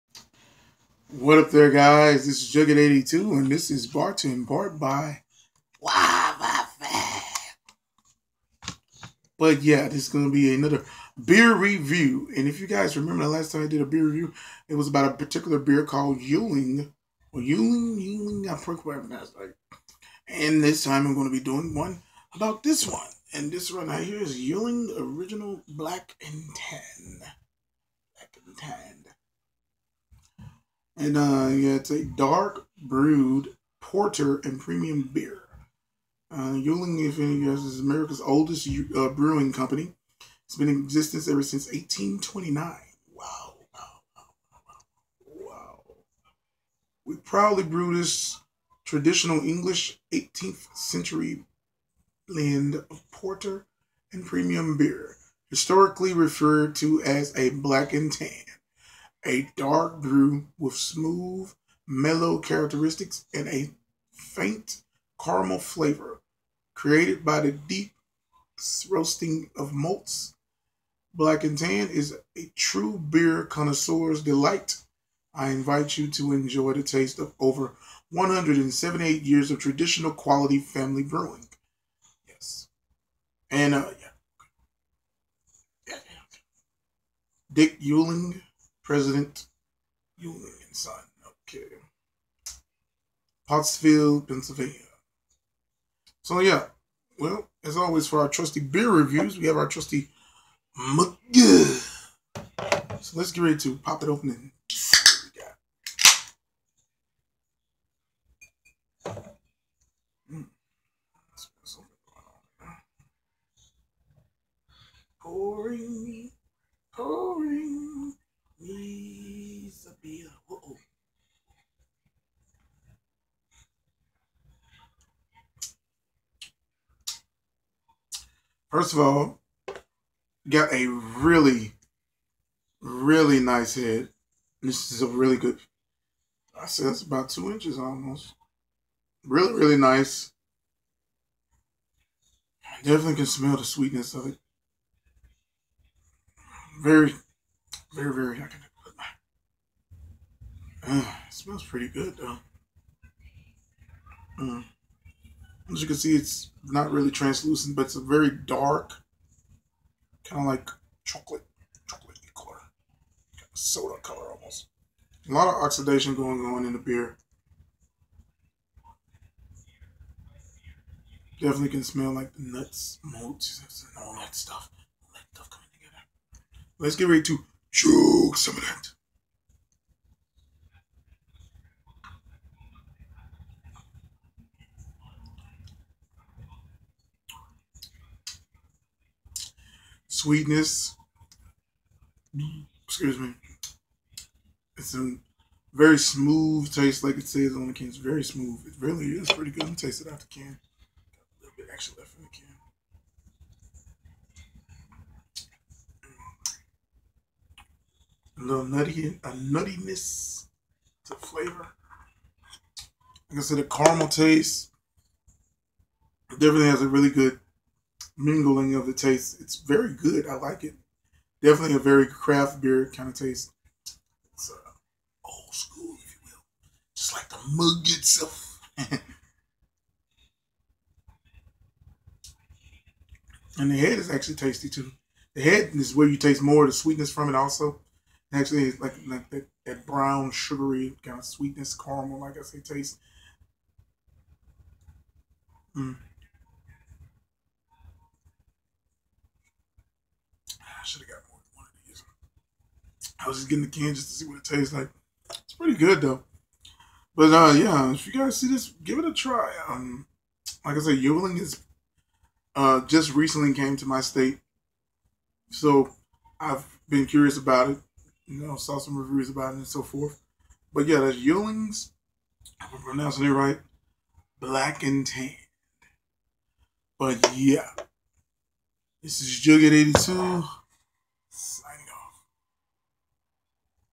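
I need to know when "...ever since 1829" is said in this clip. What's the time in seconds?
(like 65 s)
41 s.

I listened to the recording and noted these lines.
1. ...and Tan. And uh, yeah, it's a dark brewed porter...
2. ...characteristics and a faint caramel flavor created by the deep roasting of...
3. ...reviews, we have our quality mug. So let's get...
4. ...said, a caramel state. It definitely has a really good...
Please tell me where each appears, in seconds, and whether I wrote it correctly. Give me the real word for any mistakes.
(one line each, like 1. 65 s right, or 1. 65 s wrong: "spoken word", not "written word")
1. 28 s right
2. 62 s right
3. 98 s wrong: "trusty", not "quality"
4. 213 s wrong: "taste", not "state".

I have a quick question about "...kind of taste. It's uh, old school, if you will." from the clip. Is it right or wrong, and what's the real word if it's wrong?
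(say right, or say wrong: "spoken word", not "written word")
right.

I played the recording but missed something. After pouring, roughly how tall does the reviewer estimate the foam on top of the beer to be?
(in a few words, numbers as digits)
about 2 inches.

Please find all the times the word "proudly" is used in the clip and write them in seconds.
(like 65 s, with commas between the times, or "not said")
47 s.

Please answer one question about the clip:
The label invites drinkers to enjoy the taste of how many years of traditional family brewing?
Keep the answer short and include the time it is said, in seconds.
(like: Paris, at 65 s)
178, at 78 s.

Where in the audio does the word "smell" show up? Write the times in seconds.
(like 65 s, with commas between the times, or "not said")
143 s, 151 s, 171 s.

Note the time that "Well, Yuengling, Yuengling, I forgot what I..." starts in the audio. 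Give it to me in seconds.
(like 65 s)
17 s.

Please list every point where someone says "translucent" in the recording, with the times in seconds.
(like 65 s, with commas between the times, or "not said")
157 s.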